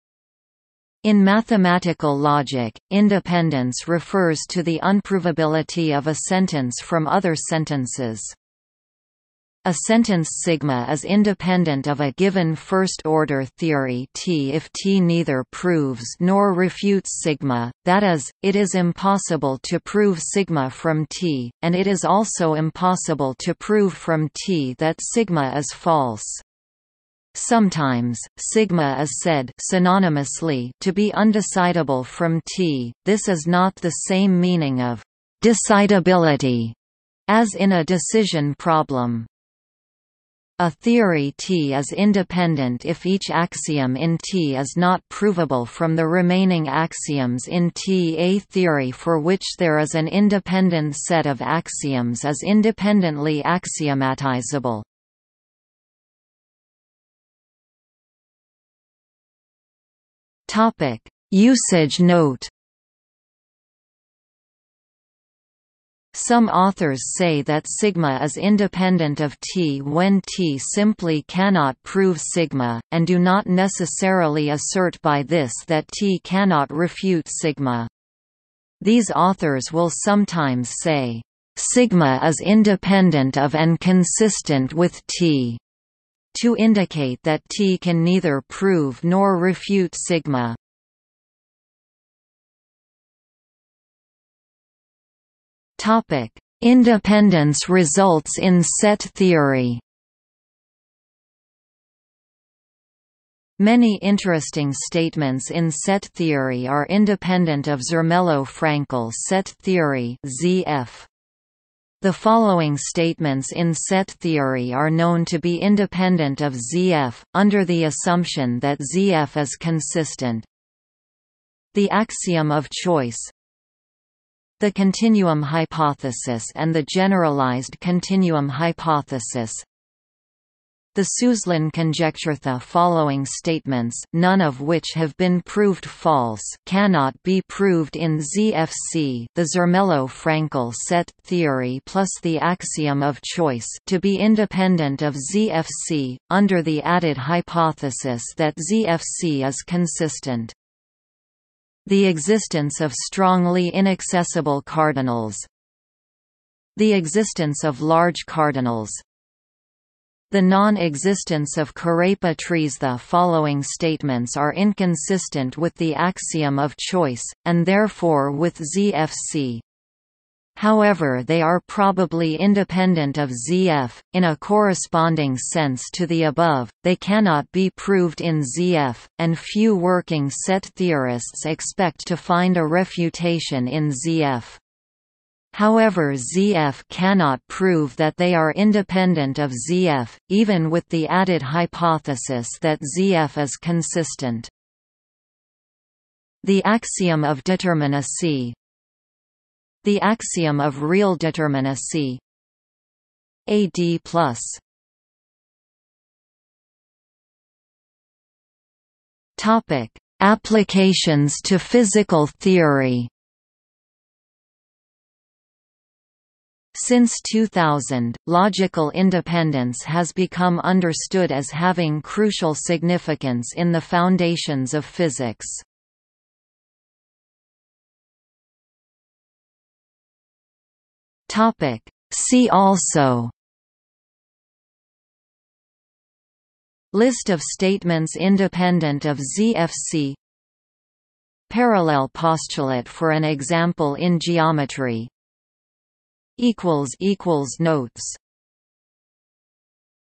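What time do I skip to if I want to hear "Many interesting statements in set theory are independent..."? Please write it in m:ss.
1:43.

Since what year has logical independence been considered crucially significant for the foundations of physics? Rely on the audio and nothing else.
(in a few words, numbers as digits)
2000.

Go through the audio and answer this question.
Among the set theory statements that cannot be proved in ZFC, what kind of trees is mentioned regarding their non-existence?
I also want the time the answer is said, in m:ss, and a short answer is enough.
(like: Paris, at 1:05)
Kurepa trees, at 2:41.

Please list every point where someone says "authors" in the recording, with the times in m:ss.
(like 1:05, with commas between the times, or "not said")
1:06, 1:19.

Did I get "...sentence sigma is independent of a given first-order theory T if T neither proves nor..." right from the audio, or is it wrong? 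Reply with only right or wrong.
right.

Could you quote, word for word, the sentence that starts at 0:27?
Sometimes, sigma is said synonymously to be undecidable from t.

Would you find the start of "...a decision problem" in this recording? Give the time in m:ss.
0:37.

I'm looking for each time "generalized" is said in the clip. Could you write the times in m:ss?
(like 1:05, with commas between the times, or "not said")
2:06.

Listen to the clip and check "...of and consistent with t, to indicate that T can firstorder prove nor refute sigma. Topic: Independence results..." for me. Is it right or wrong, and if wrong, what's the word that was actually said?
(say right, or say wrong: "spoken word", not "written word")
wrong: "neither", not "firstorder".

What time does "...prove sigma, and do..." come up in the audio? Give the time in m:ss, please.
1:11.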